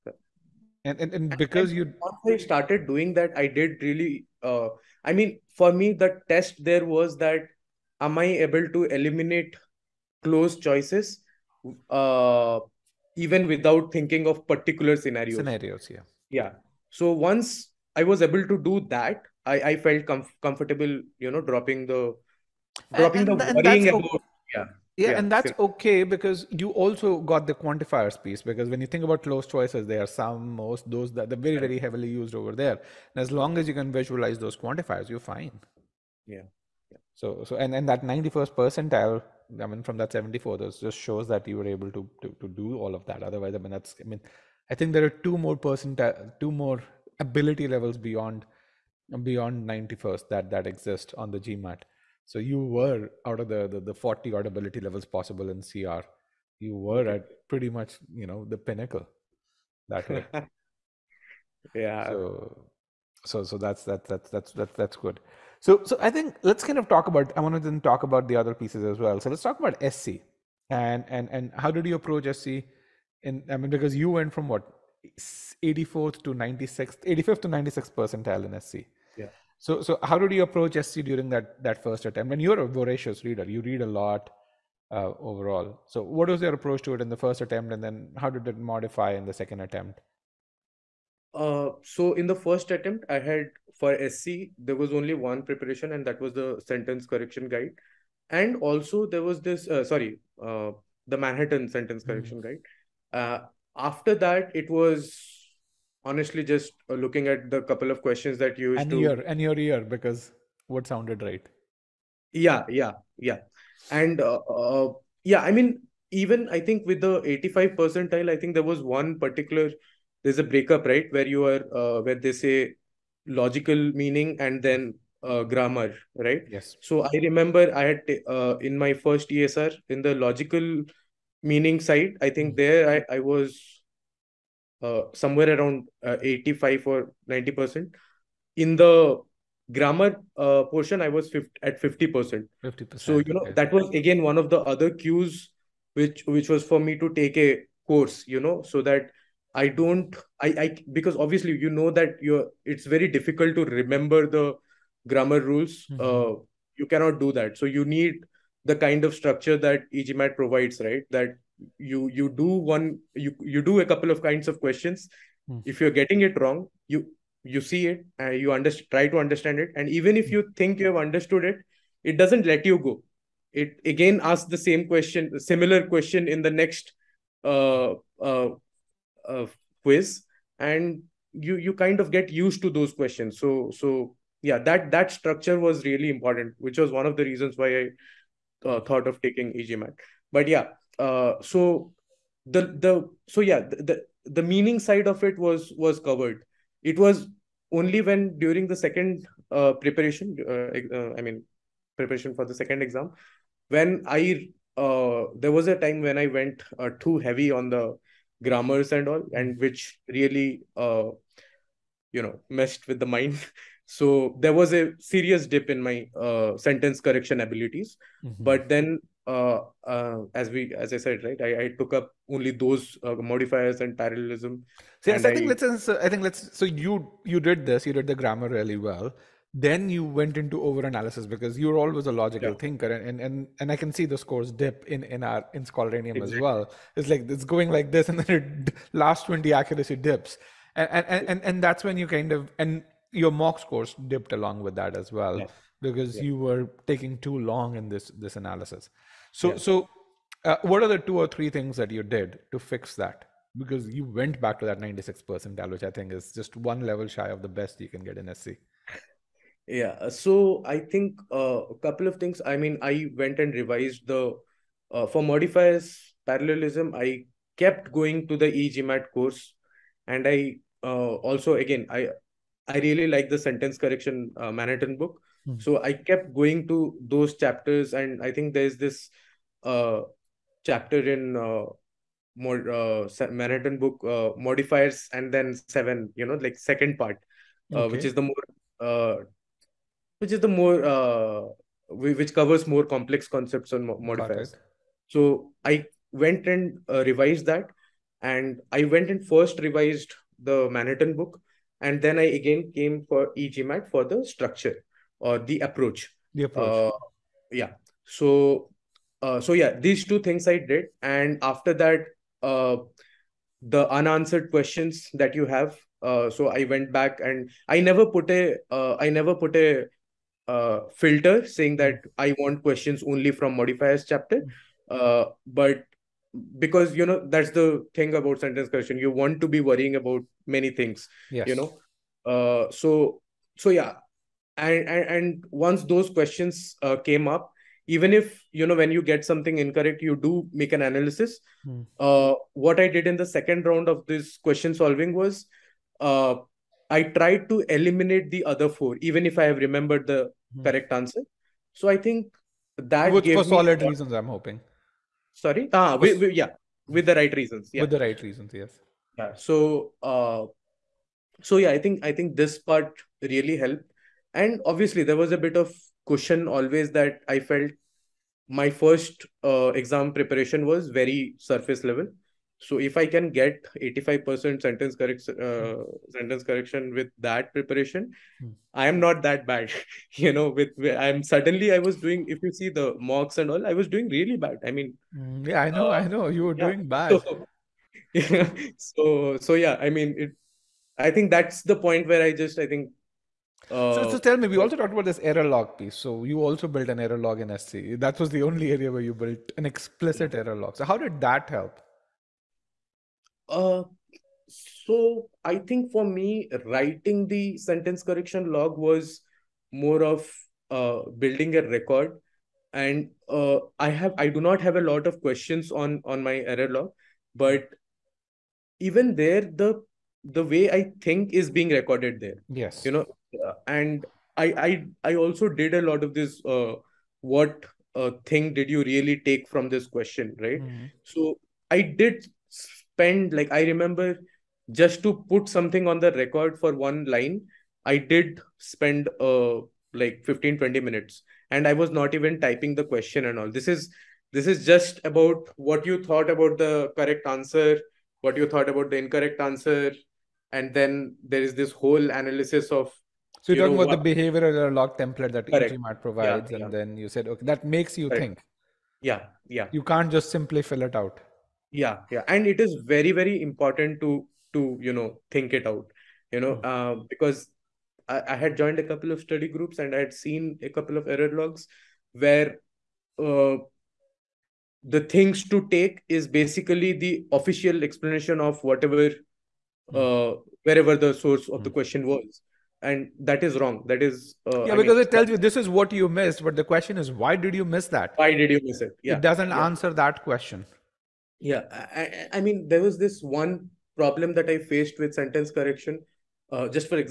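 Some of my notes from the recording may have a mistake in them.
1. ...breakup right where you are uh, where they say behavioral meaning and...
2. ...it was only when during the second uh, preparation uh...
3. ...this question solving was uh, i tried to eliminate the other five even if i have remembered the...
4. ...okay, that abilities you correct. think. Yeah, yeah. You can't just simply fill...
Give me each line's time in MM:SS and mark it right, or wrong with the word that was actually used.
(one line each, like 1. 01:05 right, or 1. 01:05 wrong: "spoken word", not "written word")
1. 02:00 wrong: "logical", not "behavioral"
2. 03:16 right
3. 05:44 wrong: "four", not "five"
4. 07:37 wrong: "makes", not "abilities".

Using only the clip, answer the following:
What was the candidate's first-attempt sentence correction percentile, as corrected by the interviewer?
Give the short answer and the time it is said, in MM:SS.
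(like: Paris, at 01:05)
85th, at 01:17.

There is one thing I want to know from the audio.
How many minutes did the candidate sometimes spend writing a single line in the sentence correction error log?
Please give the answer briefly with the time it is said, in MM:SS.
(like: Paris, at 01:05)
15 to 20 minutes, at 07:20.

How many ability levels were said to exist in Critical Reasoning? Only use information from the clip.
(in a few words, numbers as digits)
40.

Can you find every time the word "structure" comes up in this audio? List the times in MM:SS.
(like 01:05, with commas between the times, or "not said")
02:39, 03:05, 05:04.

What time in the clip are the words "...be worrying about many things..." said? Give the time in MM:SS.
05:29.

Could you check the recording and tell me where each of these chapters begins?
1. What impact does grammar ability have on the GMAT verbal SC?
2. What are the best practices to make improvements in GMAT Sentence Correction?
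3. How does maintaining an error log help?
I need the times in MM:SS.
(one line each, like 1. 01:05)
1. 01:05
2. 03:45
3. 06:33.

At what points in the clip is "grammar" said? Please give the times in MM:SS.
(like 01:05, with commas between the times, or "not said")
02:05, 02:19, 02:35, 03:28, 03:48.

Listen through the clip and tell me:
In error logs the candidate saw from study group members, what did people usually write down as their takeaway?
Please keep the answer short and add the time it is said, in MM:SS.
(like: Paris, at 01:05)
official explanation, at 07:57.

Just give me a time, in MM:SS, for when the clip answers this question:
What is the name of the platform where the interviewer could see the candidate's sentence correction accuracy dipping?
03:55.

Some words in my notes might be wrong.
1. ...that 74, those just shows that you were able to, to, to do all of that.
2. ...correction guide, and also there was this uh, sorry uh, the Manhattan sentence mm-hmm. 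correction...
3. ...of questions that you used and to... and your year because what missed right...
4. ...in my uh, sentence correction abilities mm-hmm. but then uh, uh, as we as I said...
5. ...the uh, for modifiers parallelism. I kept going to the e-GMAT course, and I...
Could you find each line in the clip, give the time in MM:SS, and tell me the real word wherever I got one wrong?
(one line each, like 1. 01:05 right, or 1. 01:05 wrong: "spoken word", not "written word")
1. 00:39 right
2. 01:37 right
3. 01:47 wrong: "sounded", not "missed"
4. 03:35 right
5. 04:24 right.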